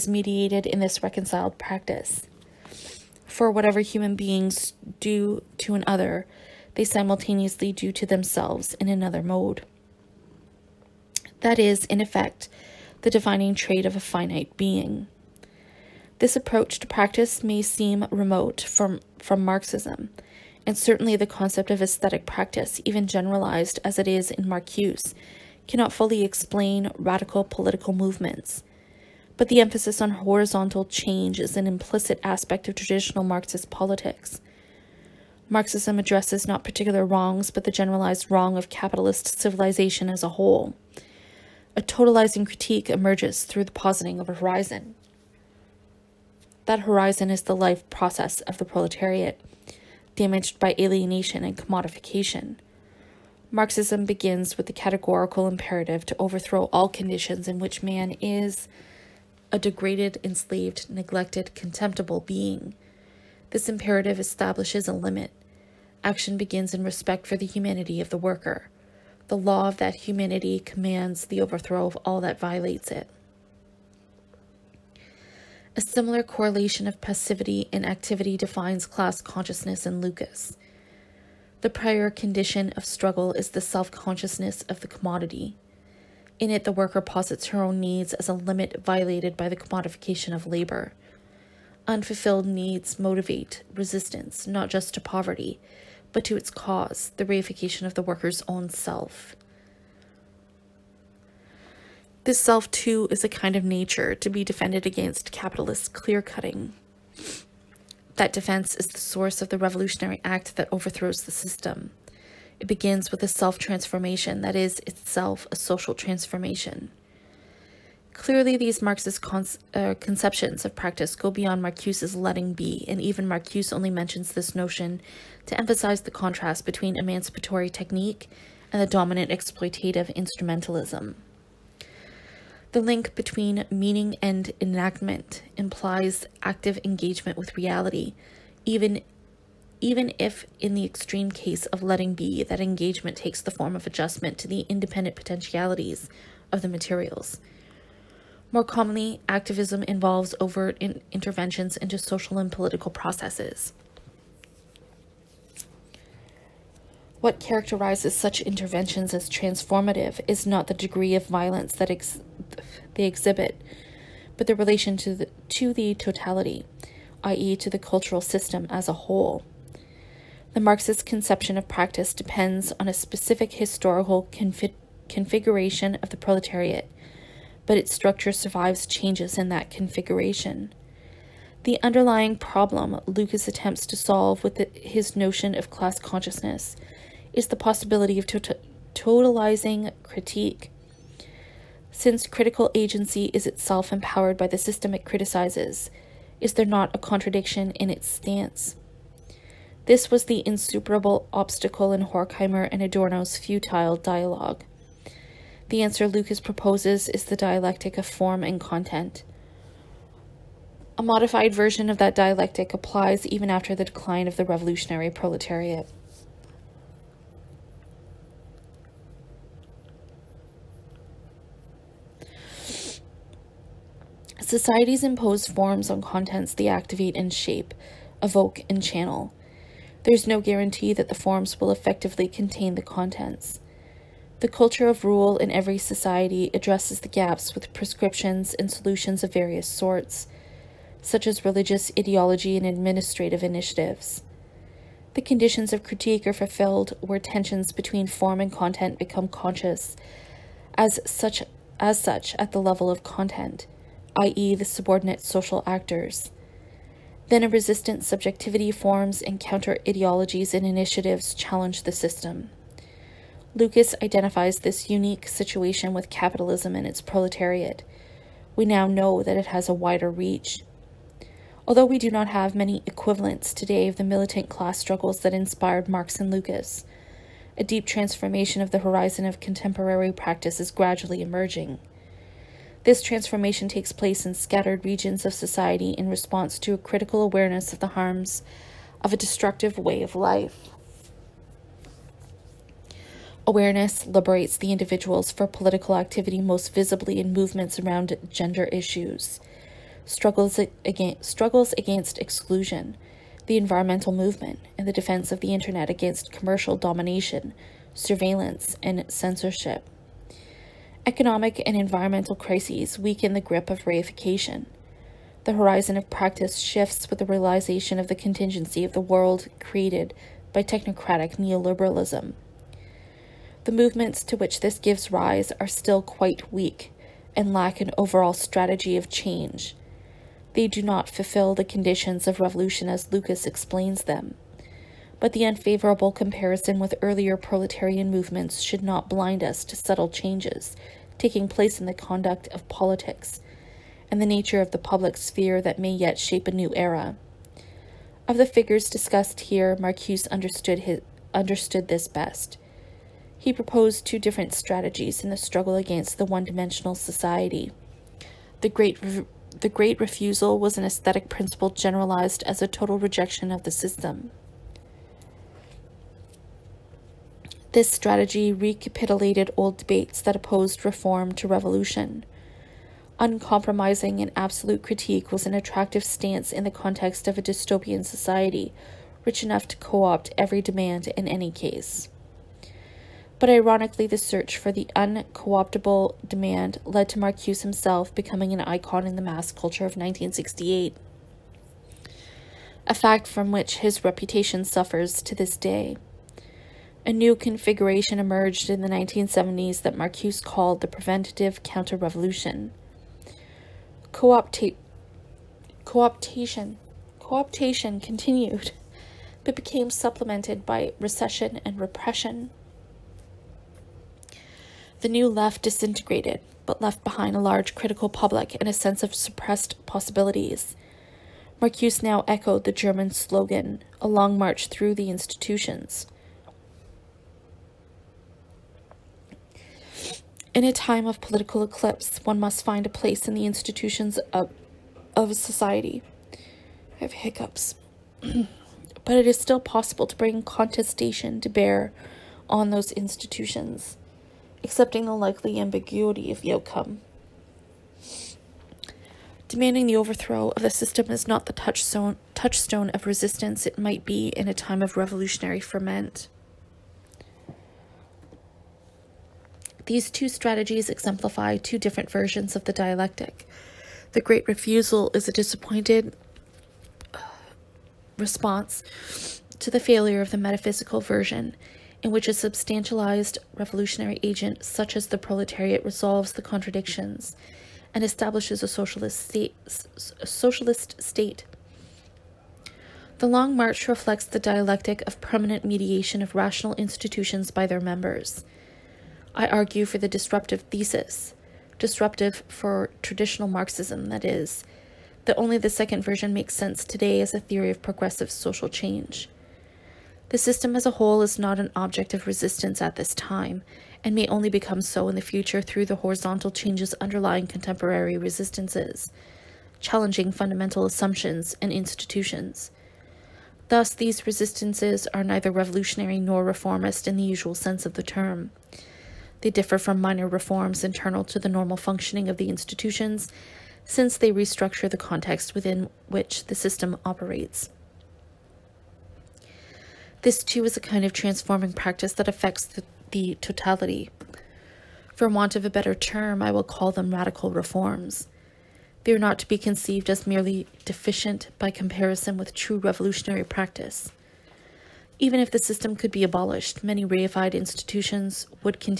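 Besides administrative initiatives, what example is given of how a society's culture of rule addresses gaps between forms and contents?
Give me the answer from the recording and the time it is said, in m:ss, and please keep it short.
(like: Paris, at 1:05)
Religious ideology, at 4:01.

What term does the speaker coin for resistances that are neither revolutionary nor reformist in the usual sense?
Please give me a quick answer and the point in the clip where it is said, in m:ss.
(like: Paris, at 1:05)
Radical reforms, at 8:57.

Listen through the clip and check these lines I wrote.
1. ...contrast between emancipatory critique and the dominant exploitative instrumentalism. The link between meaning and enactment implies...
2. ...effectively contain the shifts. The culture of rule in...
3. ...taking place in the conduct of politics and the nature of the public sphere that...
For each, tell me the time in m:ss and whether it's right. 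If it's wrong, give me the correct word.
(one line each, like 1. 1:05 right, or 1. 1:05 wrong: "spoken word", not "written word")
1. 2:06 wrong: "technique", not "critique"
2. 3:51 wrong: "contents", not "shifts"
3. 5:41 right.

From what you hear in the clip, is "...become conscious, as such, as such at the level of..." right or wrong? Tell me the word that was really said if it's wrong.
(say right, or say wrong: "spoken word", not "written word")
right.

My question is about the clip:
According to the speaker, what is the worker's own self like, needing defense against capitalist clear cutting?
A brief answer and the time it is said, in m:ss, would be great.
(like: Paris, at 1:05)
A kind of nature, at 1:43.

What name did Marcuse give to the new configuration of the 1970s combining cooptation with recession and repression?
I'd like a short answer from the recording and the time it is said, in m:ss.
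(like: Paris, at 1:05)
Preventative Counter-Revolution, at 6:40.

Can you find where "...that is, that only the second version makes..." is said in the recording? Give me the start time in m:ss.
8:14.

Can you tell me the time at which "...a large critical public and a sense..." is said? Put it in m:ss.
6:57.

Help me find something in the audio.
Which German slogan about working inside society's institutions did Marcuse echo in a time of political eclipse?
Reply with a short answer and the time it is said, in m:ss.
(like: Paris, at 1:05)
A long march through the institutions, at 7:04.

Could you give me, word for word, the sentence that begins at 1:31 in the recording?
Unfulfilled needs motivate resistance not just to poverty, but to its cause, the reification of the worker's own self.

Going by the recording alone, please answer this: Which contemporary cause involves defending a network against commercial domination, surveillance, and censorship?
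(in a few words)
The internet.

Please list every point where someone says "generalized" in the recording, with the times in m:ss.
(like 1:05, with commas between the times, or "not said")
0:23, 0:37, 6:01.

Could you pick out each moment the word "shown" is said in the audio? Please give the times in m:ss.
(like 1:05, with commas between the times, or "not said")
not said.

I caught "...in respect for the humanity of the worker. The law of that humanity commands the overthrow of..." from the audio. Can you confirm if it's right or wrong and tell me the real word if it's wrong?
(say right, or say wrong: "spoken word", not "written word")
right.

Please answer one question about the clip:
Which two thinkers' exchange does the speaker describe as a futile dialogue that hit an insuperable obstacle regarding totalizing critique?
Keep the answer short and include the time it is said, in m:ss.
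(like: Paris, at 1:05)
Horkheimer and Adorno, at 3:22.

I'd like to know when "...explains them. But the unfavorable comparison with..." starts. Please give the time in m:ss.
5:33.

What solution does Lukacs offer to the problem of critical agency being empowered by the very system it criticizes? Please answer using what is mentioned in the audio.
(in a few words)
The dialectic of form and content.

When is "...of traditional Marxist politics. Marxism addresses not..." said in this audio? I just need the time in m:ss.
0:32.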